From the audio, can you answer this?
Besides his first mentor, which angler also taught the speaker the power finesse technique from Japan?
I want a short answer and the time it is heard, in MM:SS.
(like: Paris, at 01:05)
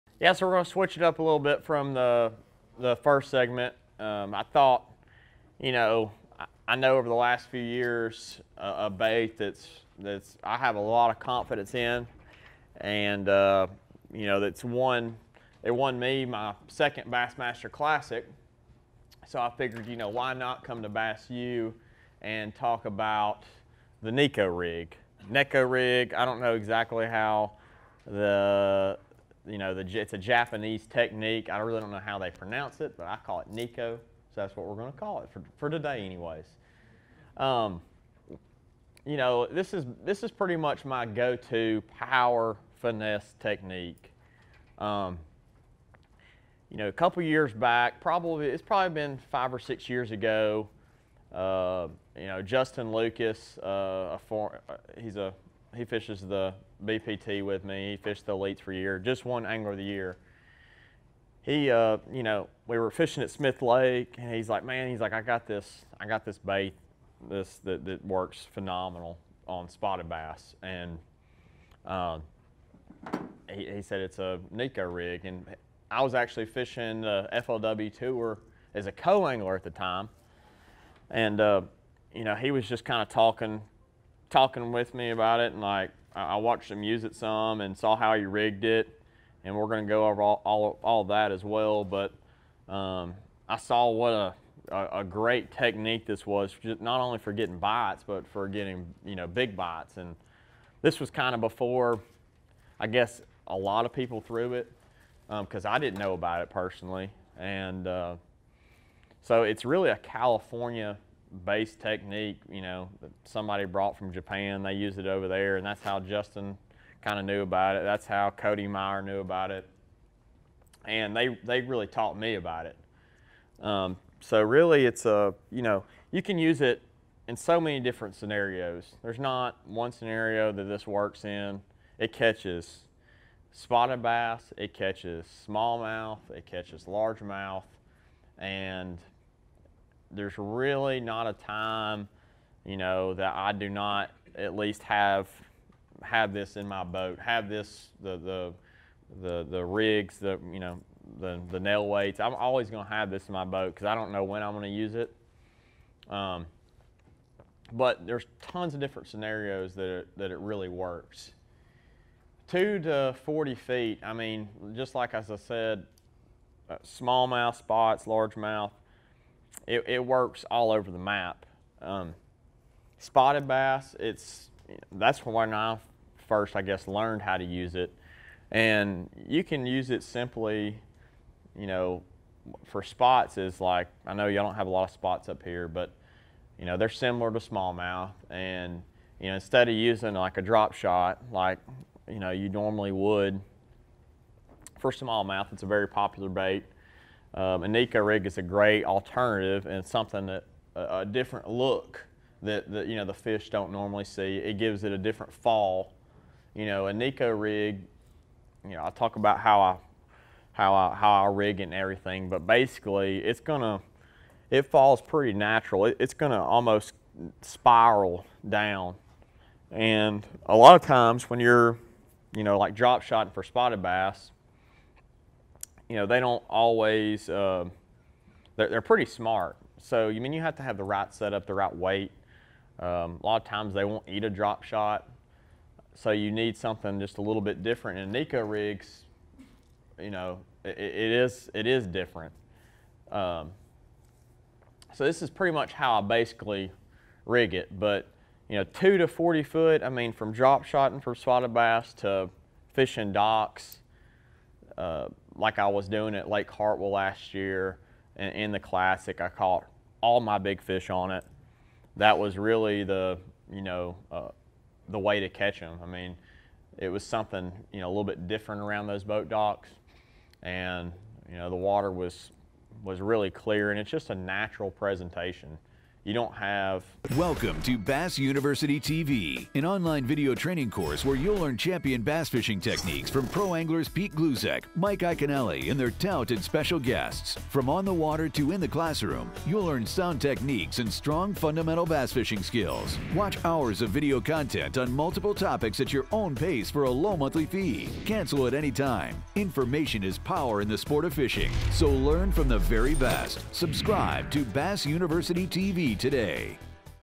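Cody Meyer, at 01:58.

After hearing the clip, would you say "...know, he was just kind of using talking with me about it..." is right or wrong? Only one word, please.
wrong.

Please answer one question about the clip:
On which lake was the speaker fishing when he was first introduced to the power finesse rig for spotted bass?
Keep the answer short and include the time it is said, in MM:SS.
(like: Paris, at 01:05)
Smith Lake, at 01:03.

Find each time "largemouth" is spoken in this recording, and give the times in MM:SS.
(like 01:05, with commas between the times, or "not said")
02:16, 02:48.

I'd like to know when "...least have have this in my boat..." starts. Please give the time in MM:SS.
02:24.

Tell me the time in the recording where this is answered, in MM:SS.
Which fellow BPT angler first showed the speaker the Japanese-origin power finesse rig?
00:52.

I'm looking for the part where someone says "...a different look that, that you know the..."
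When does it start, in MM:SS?
03:20.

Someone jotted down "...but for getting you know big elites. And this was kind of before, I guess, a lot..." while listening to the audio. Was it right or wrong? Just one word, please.
wrong.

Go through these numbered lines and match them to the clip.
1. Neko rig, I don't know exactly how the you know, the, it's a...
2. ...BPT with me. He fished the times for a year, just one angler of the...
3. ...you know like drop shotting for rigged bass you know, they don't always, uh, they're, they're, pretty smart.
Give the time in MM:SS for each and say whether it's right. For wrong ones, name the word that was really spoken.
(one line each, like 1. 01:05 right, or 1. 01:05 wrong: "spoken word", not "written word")
1. 00:25 right
2. 00:56 wrong: "elites", not "times"
3. 03:42 wrong: "spotted", not "rigged".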